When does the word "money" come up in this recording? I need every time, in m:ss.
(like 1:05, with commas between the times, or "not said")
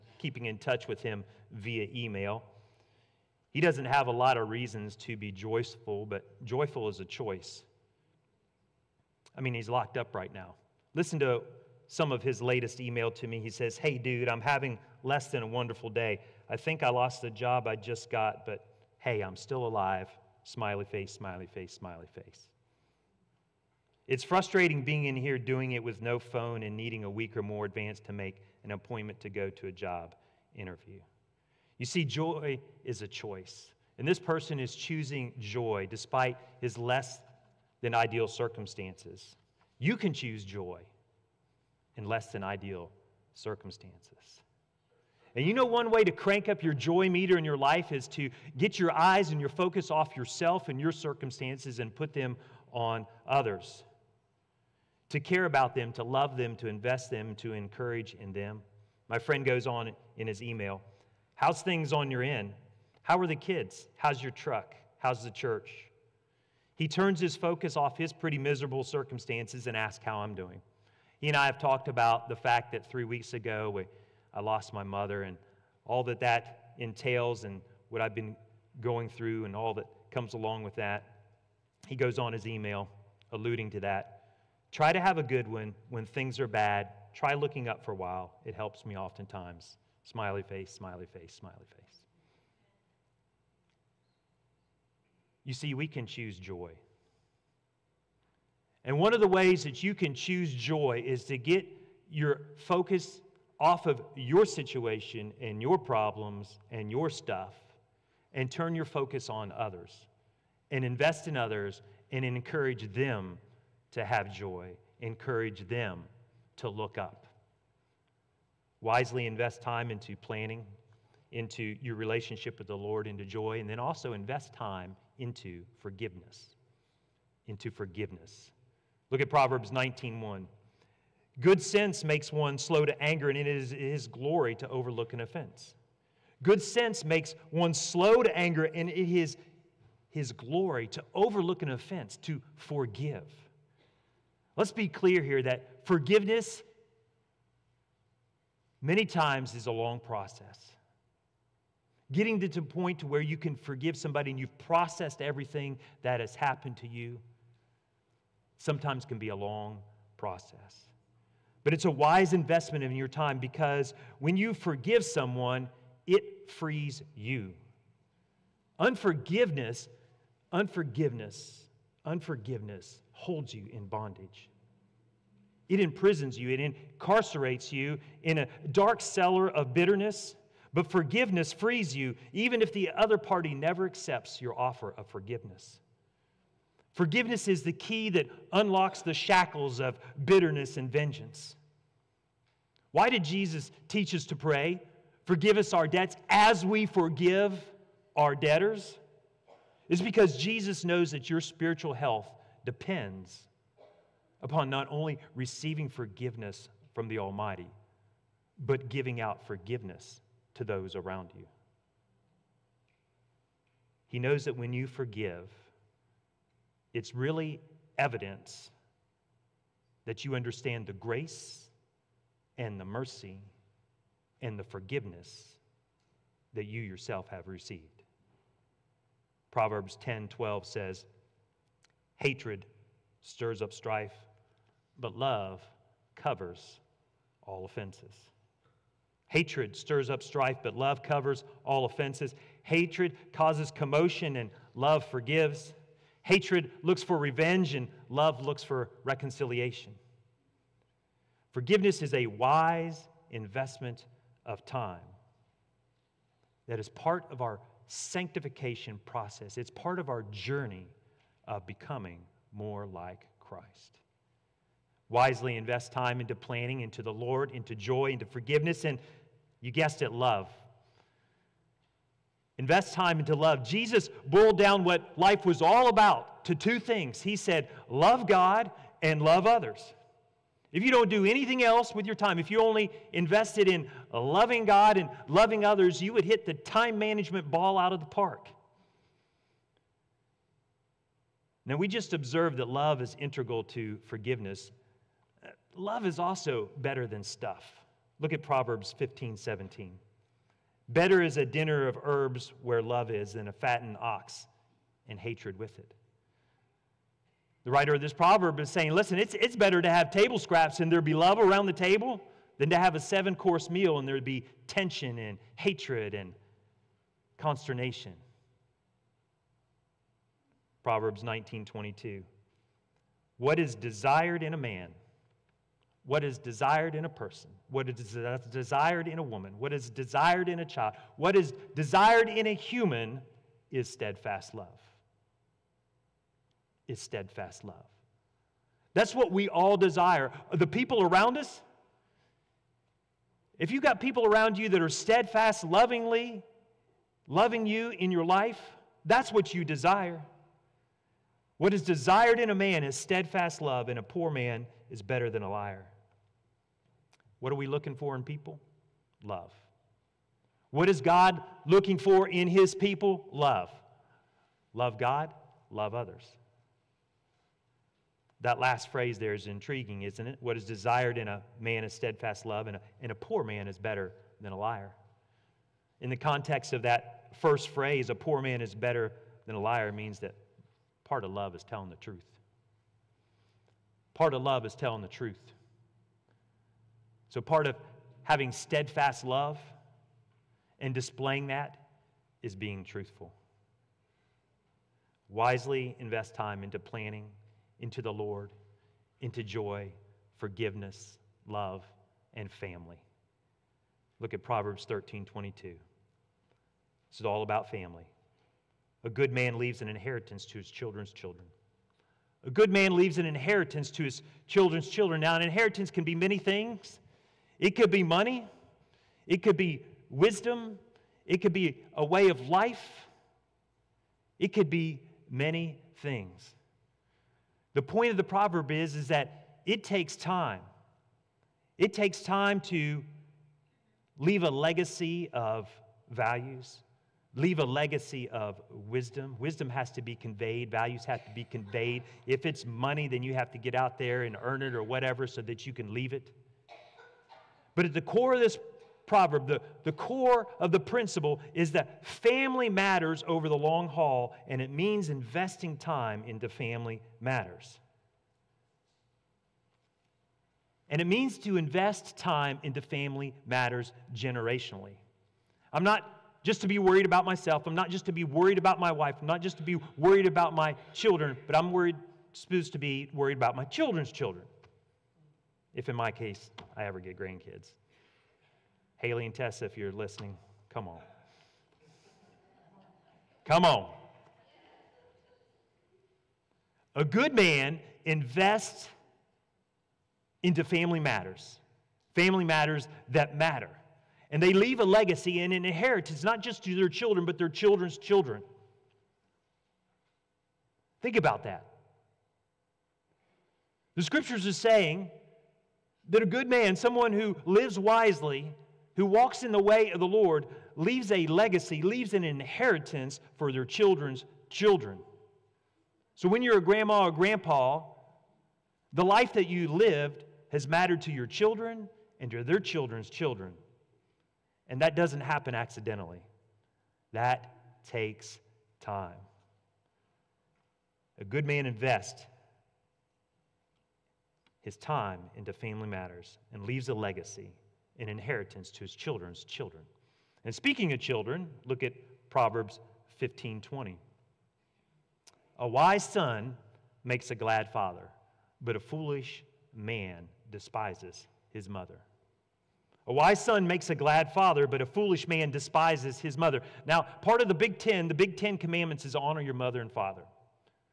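6:58, 7:22.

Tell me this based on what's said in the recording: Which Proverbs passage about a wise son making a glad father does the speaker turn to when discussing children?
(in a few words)
Proverbs 15:20.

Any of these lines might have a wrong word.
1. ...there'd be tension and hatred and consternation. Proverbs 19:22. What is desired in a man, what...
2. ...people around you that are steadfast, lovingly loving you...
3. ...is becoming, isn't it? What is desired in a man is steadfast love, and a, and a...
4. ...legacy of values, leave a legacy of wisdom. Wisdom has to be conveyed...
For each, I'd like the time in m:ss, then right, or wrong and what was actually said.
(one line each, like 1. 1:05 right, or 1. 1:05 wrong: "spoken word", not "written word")
1. 5:14 right
2. 5:43 right
3. 6:09 wrong: "intriguing", not "becoming"
4. 7:14 right.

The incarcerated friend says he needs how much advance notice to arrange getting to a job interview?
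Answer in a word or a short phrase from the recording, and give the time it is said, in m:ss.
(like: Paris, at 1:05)
a week or more, at 0:27.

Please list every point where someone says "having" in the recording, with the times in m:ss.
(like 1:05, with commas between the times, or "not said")
0:14, 6:28.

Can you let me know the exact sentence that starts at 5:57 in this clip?
What are we looking for in people?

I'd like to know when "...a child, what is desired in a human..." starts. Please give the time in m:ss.
5:30.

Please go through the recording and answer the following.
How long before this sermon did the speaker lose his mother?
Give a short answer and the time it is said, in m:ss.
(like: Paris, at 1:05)
three weeks, at 1:12.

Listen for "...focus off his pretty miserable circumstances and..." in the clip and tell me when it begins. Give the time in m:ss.
1:07.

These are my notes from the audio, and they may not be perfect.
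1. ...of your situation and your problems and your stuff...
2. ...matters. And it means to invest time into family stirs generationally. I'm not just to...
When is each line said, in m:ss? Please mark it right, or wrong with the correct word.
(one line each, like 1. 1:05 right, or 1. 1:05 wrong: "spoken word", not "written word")
1. 1:43 right
2. 7:37 wrong: "matters", not "stirs".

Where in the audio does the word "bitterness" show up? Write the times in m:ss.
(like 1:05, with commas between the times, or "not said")
2:59, 3:10.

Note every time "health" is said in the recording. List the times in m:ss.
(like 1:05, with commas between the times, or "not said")
3:21.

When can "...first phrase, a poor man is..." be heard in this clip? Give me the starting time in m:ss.
6:17.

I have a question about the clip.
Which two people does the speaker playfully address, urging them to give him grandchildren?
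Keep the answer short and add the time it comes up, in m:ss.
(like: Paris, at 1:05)
Haley and Tessa, at 7:58.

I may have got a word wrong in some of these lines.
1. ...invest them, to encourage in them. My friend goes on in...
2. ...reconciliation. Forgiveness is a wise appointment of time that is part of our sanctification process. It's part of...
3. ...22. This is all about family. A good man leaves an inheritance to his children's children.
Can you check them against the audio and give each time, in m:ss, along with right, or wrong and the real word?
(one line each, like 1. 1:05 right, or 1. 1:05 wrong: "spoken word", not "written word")
1. 0:56 right
2. 4:09 wrong: "investment", not "appointment"
3. 6:45 right.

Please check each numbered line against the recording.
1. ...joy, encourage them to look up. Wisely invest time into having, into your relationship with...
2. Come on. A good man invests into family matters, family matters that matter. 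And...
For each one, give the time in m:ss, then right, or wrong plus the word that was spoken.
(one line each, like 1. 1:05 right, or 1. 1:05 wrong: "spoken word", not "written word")
1. 1:54 wrong: "planning", not "having"
2. 8:03 right.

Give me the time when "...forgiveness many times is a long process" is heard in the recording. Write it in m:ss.
2:25.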